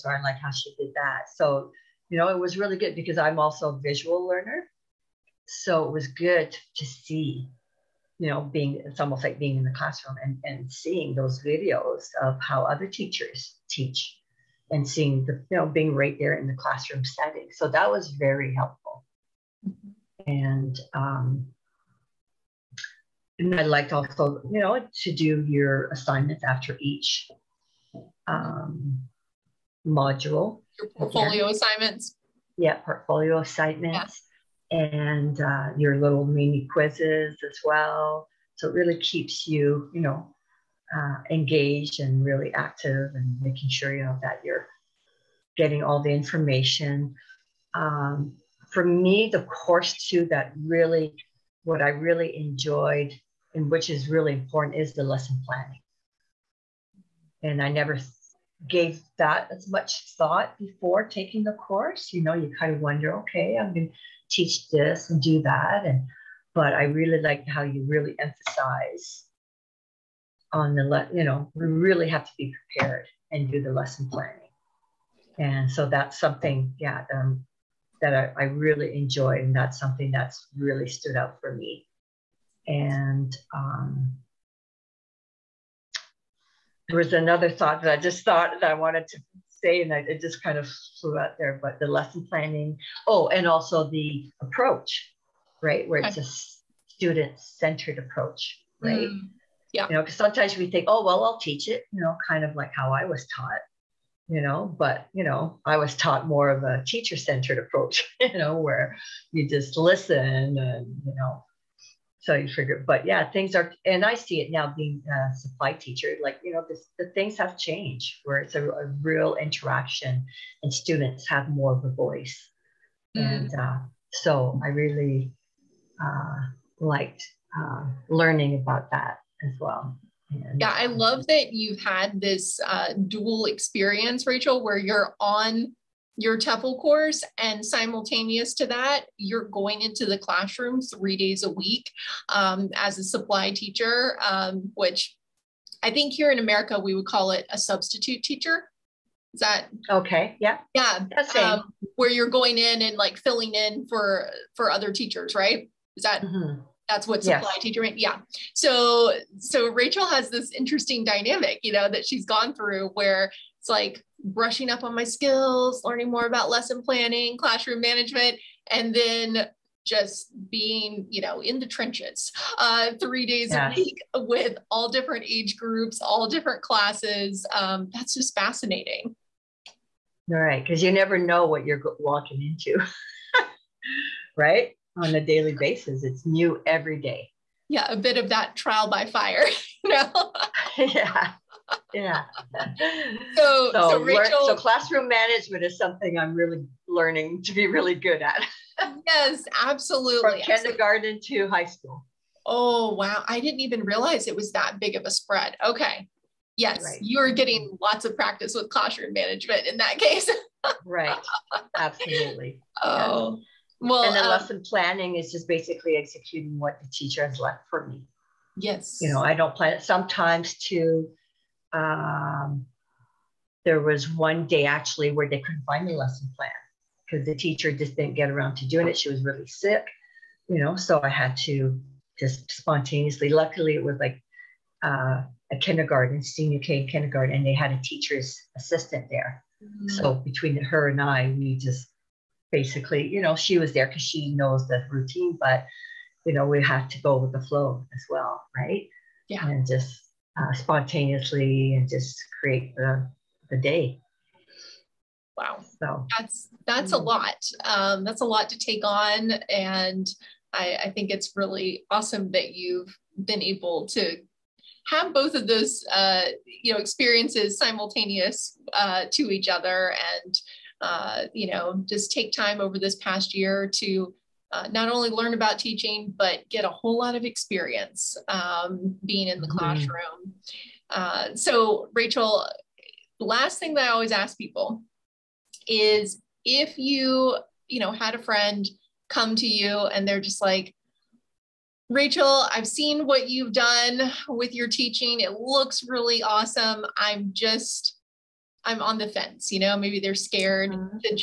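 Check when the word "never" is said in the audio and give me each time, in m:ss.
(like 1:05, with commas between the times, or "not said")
0:57, 3:00.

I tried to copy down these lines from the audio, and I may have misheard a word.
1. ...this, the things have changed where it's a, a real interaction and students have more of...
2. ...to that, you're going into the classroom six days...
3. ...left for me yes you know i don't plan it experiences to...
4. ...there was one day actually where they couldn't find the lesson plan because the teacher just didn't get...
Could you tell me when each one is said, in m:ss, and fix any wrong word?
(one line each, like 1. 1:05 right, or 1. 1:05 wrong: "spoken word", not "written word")
1. 1:56 right
2. 2:18 wrong: "three", not "six"
3. 3:37 wrong: "sometimes", not "experiences"
4. 3:43 right.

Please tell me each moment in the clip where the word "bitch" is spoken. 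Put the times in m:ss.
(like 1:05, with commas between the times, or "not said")
not said.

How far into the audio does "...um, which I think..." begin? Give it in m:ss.
2:24.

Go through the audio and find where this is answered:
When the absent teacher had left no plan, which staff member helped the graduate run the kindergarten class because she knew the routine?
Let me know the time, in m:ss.
3:57.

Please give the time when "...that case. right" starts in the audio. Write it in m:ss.
3:29.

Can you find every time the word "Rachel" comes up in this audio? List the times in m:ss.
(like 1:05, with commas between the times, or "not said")
2:14, 2:39, 3:14, 4:41, 4:51.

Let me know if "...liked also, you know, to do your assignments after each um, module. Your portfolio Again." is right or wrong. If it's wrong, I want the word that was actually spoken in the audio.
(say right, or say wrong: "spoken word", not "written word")
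right.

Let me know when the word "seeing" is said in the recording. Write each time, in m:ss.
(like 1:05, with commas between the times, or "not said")
0:10, 0:14.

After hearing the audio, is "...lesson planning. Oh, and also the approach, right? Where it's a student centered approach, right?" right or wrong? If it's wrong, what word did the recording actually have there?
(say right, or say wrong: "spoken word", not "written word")
right.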